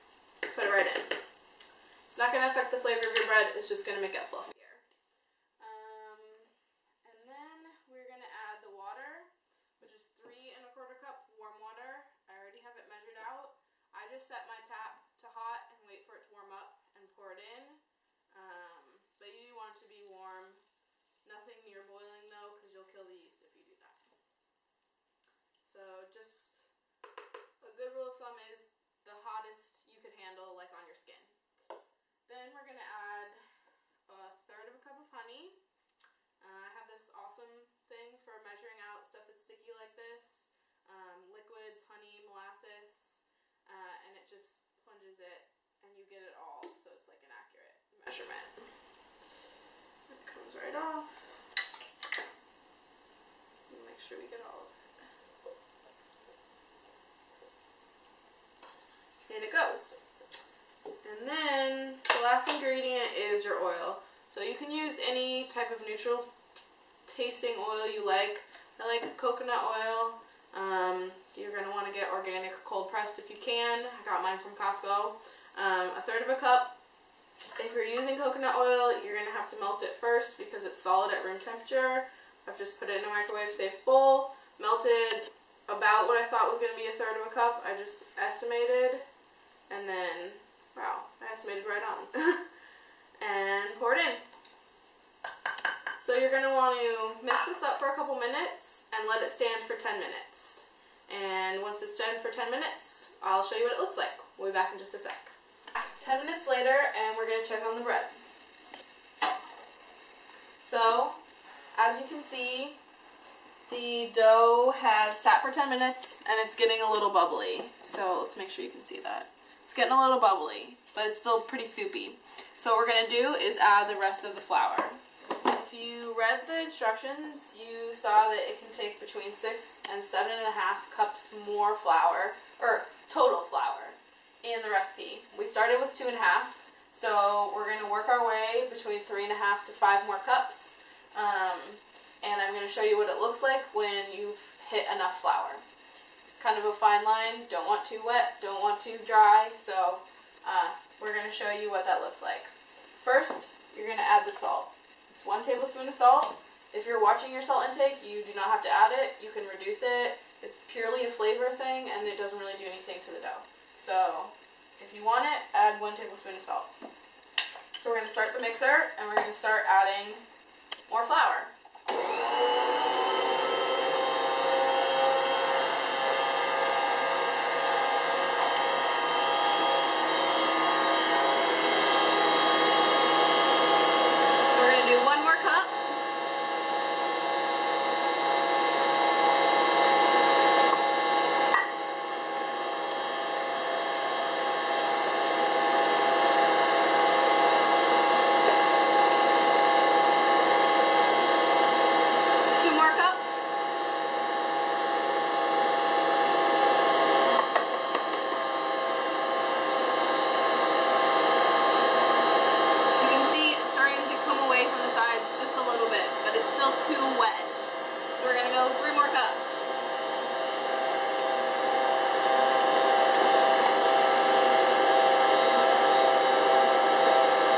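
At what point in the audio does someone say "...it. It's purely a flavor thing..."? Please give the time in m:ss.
2:39.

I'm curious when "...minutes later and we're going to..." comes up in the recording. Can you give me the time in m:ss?
1:46.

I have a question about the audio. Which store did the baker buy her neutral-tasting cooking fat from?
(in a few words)
Costco.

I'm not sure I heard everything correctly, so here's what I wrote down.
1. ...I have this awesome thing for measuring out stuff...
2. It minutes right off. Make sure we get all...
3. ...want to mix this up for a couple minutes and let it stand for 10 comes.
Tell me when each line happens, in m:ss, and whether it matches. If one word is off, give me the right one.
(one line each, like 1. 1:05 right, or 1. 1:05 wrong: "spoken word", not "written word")
1. 0:36 right
2. 0:50 wrong: "comes", not "minutes"
3. 1:36 wrong: "minutes", not "comes".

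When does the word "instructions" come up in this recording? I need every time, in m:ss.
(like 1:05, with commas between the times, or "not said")
2:06.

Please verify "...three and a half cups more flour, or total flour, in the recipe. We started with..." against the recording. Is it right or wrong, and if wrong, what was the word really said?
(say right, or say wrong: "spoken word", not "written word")
wrong: "seven", not "three".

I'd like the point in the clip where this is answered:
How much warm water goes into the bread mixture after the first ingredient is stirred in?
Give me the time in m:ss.
0:10.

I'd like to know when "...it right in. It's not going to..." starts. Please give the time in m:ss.
0:00.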